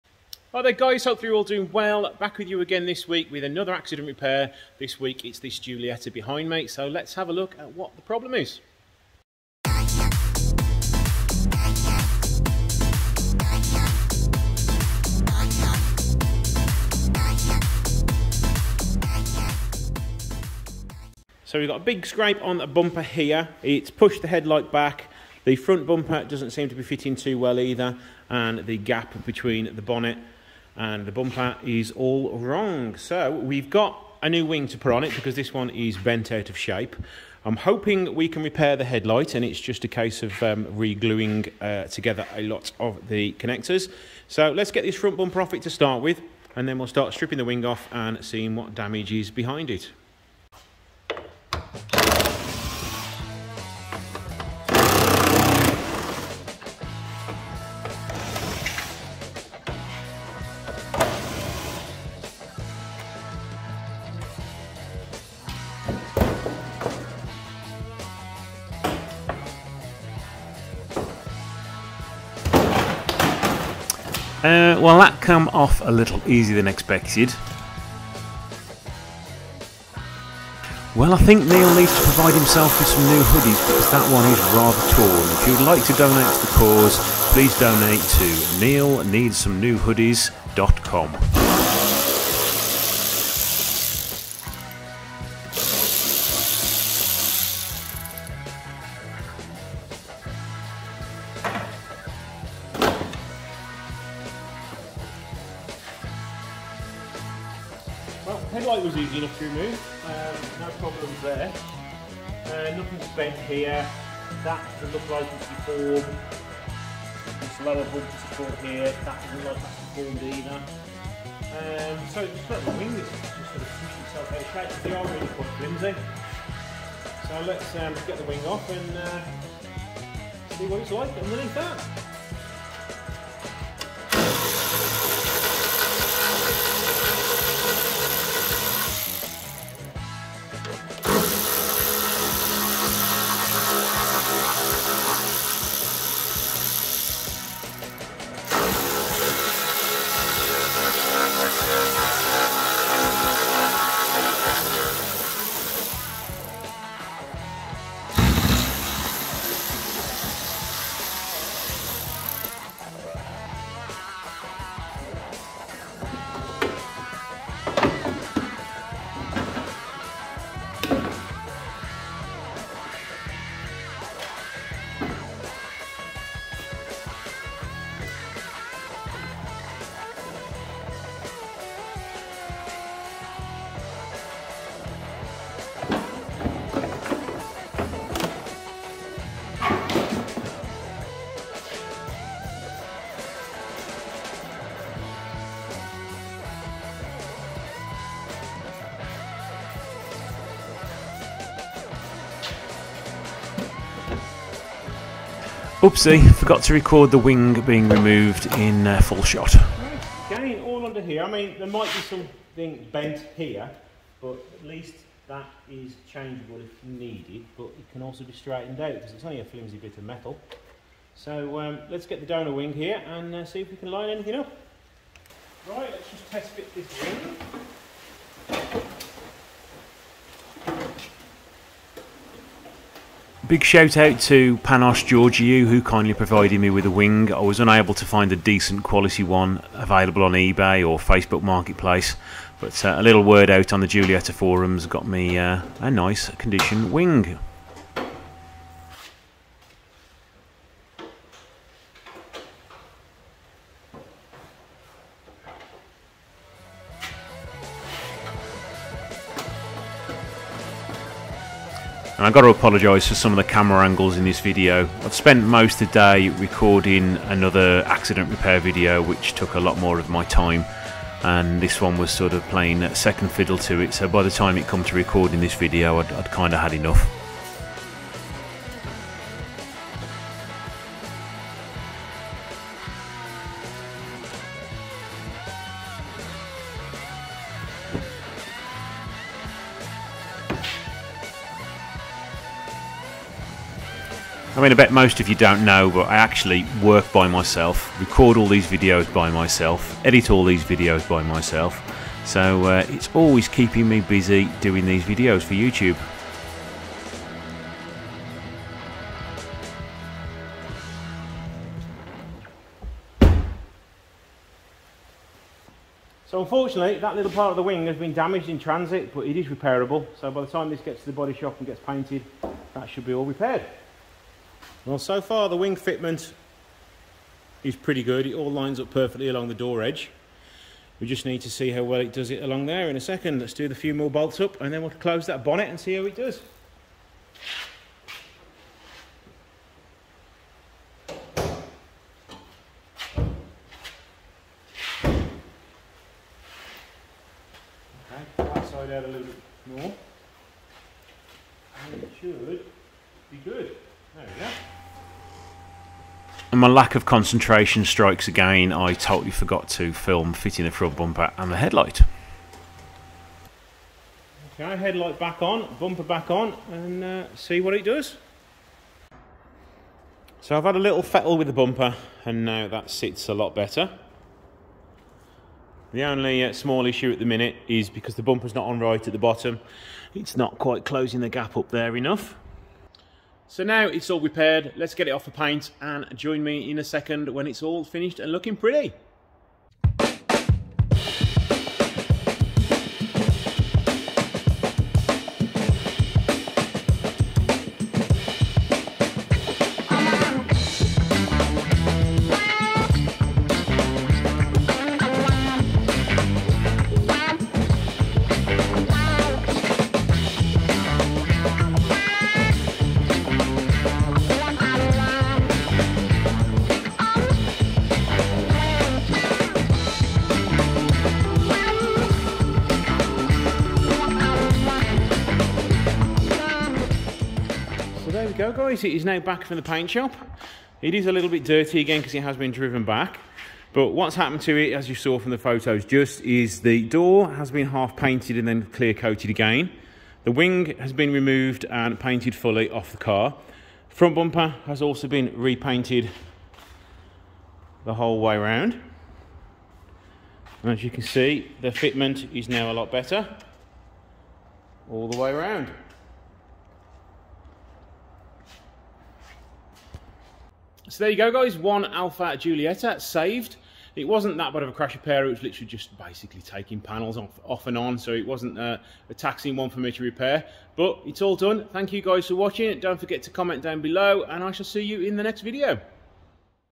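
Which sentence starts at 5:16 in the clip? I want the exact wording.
So unfortunately, that little part of the wing has been damaged in transit, but it is repairable.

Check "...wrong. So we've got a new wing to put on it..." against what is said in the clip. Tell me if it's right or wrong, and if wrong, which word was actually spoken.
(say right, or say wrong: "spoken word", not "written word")
right.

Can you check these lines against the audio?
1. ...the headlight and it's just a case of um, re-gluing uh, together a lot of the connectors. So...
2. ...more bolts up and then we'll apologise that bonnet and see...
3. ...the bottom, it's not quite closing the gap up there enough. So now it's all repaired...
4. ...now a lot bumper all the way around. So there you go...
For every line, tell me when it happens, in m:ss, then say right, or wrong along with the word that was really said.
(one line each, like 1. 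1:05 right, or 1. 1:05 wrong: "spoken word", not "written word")
1. 0:38 right
2. 5:33 wrong: "close", not "apologise"
3. 6:19 right
4. 7:32 wrong: "better", not "bumper".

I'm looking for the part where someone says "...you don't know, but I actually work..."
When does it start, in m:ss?
4:55.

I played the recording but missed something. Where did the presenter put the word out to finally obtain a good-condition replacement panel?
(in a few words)
Giulietta forums.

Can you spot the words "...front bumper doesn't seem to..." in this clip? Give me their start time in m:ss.
0:25.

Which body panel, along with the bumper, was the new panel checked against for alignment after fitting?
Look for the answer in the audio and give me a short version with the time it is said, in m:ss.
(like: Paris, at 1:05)
door edge, at 5:29.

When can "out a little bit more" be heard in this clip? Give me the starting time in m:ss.
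5:48.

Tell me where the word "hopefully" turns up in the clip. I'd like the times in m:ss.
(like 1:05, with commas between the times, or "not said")
0:01.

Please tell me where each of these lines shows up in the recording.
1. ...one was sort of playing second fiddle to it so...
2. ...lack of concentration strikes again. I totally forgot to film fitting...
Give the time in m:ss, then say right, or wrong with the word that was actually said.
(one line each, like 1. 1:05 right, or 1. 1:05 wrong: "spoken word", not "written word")
1. 4:31 right
2. 5:56 right.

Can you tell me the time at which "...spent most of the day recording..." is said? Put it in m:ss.
4:25.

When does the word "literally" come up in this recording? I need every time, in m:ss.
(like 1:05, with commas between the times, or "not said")
7:45.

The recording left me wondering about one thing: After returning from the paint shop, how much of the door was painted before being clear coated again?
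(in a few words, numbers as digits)
Half.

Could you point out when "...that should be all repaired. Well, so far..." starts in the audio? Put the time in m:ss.
5:22.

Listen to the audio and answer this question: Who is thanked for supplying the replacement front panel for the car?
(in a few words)
Panos Georgiou.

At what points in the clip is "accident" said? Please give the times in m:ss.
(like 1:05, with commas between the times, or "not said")
0:03, 4:27.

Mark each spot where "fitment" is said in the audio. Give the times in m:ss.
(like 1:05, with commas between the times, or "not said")
5:25, 7:31.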